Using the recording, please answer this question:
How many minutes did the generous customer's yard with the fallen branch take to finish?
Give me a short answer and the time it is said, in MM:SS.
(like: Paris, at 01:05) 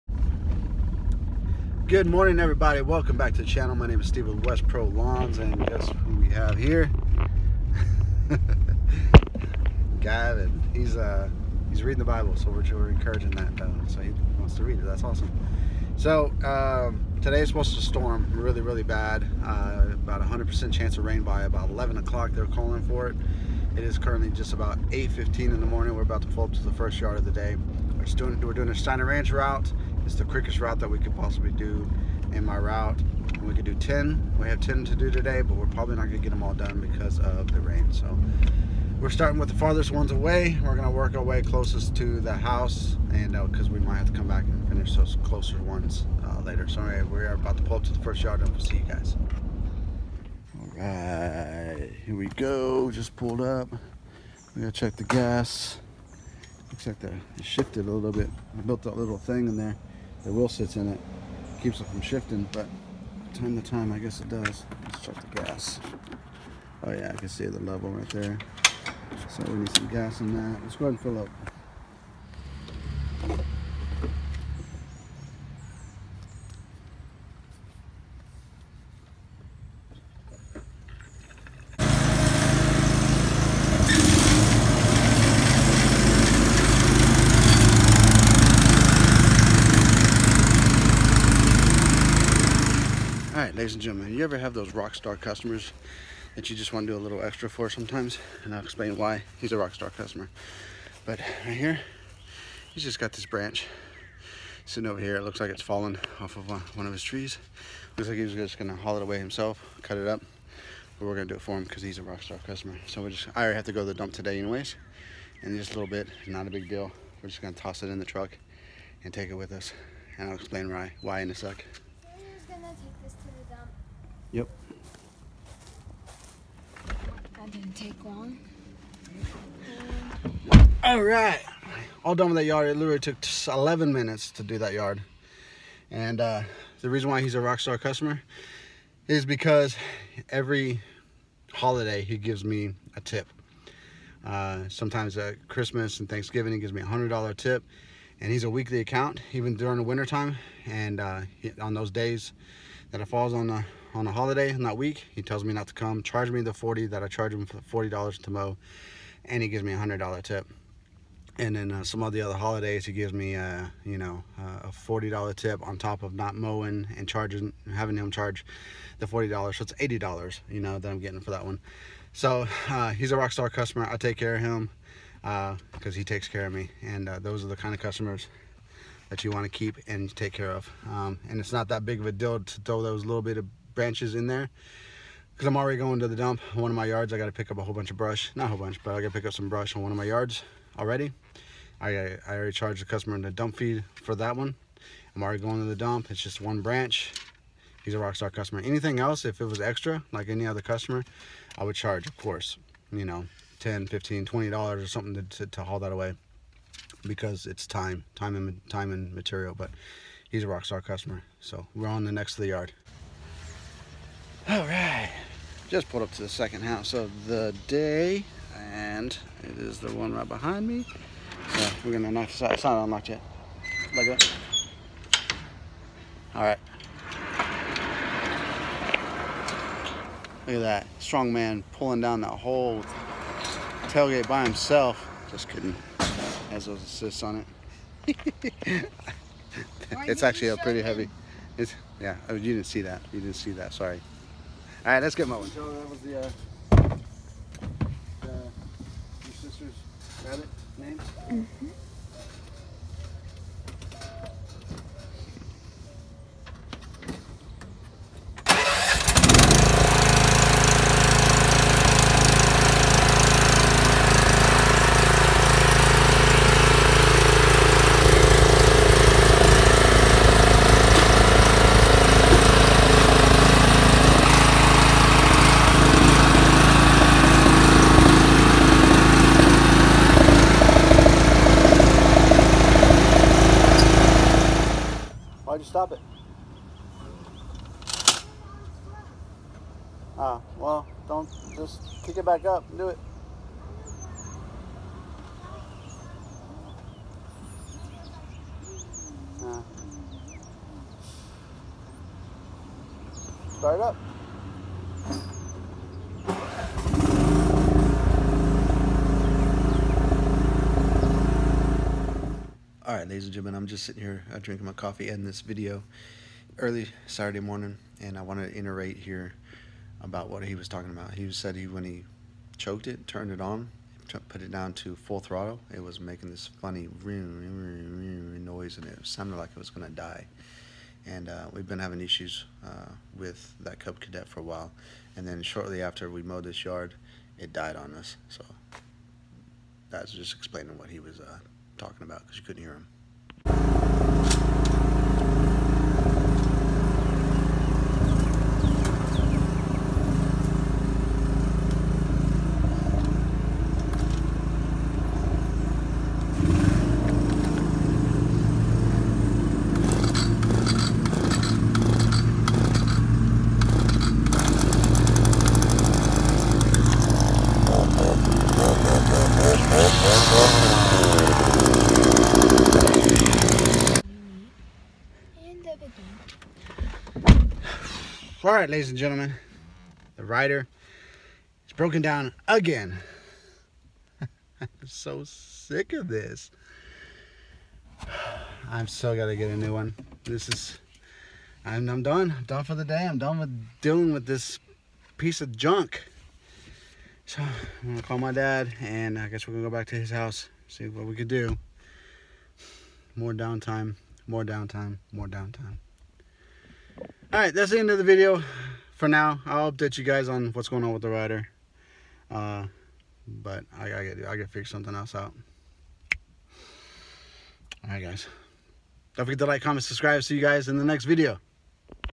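11, at 02:13.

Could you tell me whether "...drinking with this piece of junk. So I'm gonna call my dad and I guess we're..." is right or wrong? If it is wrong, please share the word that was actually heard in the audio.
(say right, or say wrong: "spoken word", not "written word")
wrong: "dealing", not "drinking".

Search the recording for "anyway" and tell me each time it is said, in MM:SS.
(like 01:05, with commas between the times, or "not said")
00:46, 01:54.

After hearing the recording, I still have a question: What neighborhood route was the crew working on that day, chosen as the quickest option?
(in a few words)
Steiner Ranch.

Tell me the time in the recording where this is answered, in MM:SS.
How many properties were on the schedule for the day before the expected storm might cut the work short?
00:34.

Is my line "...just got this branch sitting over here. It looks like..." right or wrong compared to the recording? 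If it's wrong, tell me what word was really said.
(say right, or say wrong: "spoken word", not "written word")
right.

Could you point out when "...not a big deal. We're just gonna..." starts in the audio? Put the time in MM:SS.
01:56.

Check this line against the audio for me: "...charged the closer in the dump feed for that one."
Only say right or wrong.
wrong.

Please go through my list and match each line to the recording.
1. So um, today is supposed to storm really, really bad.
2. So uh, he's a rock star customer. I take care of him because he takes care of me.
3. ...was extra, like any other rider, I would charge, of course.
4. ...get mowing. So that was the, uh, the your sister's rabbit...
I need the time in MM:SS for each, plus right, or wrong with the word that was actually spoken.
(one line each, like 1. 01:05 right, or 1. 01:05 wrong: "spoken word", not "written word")
1. 00:15 right
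2. 02:52 right
3. 03:19 wrong: "customer", not "rider"
4. 04:05 right.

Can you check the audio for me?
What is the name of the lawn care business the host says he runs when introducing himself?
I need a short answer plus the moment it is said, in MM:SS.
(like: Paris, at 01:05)
West Pro Lawns, at 00:04.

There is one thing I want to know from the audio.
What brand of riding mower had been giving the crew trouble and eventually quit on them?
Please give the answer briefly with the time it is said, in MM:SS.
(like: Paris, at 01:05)
Cub Cadet, at 05:33.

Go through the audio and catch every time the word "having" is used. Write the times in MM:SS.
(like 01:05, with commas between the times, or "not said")
02:47, 05:31.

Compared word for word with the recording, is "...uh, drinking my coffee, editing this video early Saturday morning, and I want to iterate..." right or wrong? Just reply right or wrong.
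right.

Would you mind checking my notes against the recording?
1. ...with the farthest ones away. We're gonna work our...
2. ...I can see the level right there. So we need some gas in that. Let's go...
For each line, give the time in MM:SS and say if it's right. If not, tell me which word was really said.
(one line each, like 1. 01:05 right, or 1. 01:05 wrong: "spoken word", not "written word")
1. 00:39 right
2. 01:07 right.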